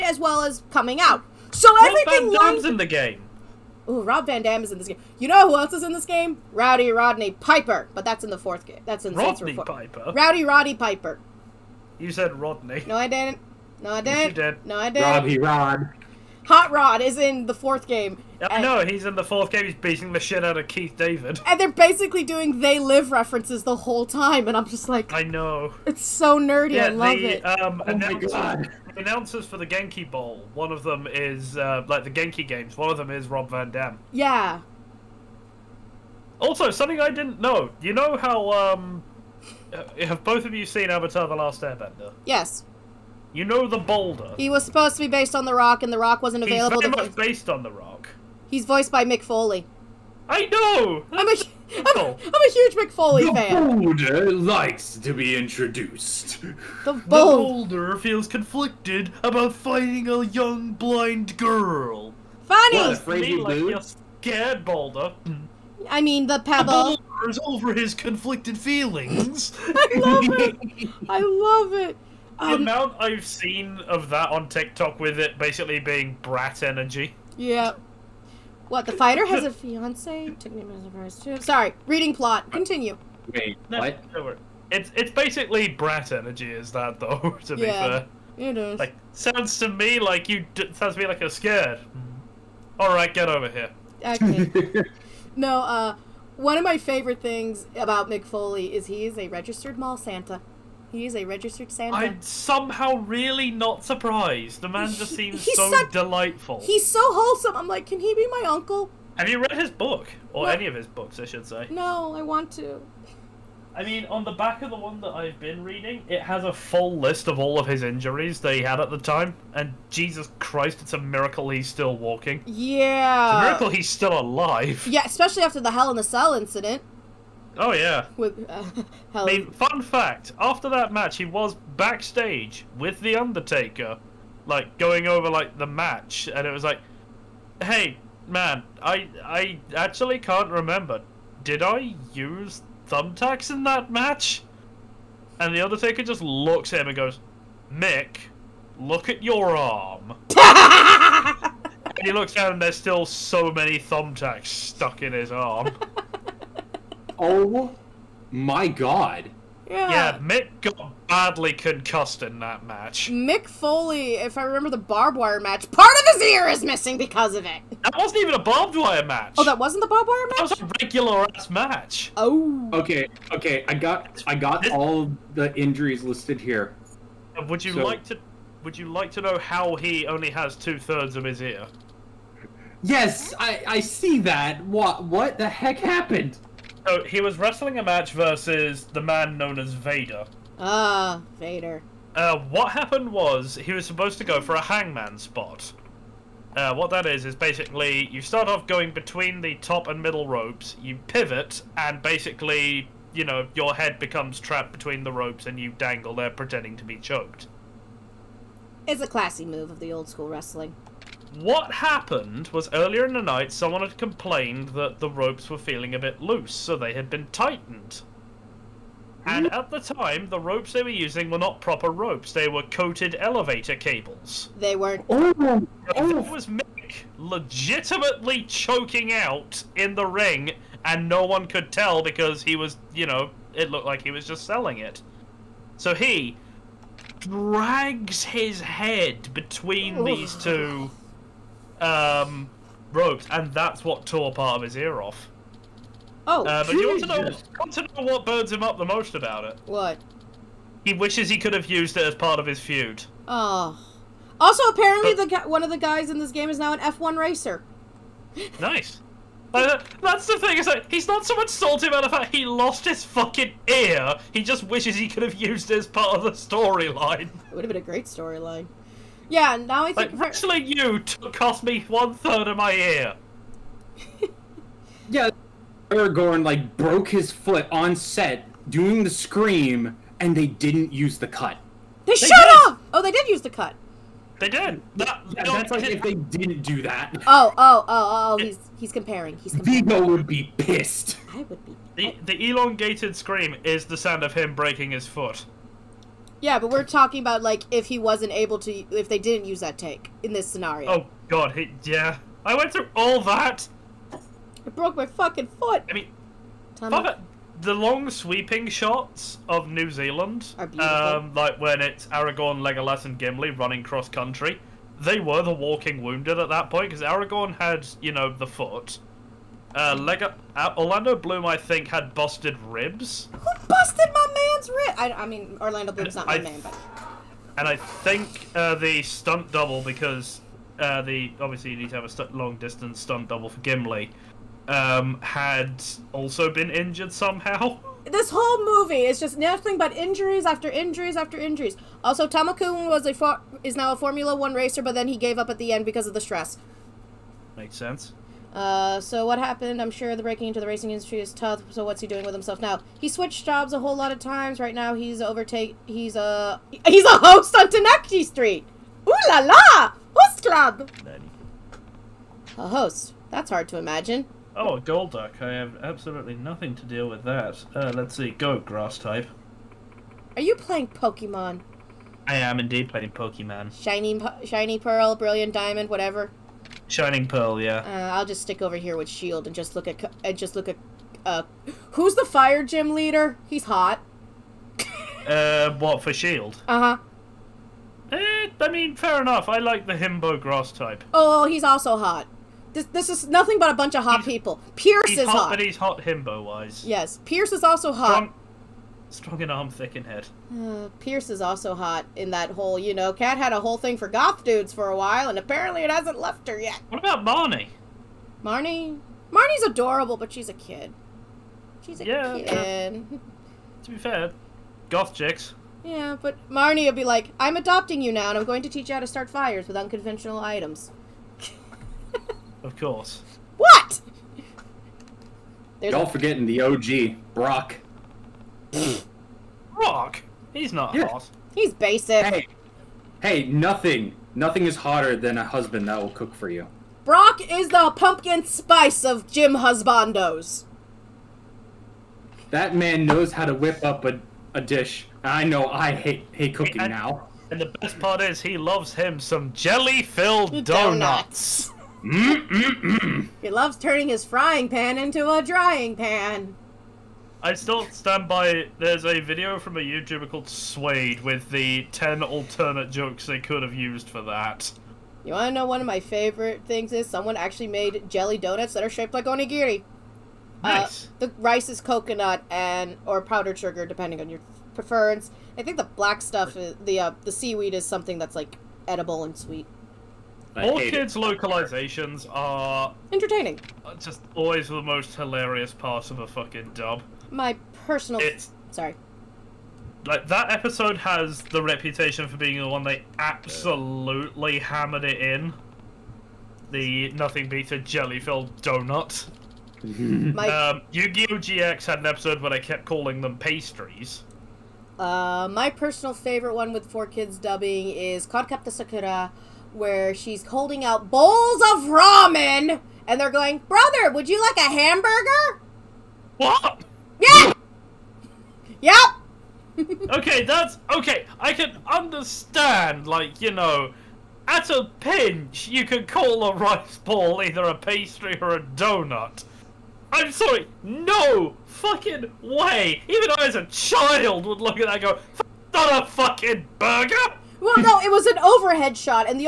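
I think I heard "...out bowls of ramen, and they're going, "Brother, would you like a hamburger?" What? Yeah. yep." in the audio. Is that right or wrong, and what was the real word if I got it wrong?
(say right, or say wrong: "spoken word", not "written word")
right.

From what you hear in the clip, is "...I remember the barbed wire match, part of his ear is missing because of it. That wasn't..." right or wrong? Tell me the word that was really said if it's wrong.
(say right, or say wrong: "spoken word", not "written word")
right.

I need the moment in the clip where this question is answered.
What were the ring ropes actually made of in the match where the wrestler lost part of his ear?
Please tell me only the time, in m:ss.
3:42.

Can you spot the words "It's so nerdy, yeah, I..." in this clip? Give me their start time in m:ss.
0:25.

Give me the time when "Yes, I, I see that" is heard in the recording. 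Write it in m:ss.
3:02.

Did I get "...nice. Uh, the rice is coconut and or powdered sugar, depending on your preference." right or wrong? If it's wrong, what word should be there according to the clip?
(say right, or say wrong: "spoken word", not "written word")
right.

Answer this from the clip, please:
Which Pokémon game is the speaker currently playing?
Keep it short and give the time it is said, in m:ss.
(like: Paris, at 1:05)
Shining Pearl, at 6:16.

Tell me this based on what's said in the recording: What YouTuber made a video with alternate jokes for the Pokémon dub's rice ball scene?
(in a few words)
Suede.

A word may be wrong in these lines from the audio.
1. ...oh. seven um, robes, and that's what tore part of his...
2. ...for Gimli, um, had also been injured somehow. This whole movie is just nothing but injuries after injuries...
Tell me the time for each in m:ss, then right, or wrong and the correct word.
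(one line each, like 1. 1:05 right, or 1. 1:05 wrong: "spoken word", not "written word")
1. 4:00 wrong: "two", not "seven"
2. 5:33 right.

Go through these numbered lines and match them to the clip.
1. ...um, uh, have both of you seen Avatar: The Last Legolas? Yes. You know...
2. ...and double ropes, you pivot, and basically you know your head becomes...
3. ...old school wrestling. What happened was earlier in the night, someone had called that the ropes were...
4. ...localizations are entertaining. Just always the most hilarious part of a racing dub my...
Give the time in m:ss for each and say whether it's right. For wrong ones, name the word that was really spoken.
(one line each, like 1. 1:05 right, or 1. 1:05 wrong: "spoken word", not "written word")
1. 0:38 wrong: "Airbender", not "Legolas"
2. 3:19 wrong: "middle", not "double"
3. 3:29 wrong: "complained", not "called"
4. 8:01 wrong: "fucking", not "racing".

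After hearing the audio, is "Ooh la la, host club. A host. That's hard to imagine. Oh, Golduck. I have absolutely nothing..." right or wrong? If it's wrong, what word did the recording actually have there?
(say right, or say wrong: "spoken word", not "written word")
right.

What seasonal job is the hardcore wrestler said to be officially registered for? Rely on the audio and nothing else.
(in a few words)
Mall Santa.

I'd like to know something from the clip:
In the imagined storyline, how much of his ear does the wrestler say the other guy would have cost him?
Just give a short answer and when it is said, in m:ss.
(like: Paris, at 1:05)
One third, at 4:31.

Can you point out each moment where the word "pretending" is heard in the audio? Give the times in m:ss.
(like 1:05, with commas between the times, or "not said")
3:26.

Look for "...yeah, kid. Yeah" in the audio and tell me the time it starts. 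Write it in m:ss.
6:52.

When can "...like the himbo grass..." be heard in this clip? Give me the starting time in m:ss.
6:29.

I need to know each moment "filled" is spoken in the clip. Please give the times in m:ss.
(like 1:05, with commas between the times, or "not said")
7:29, 8:17.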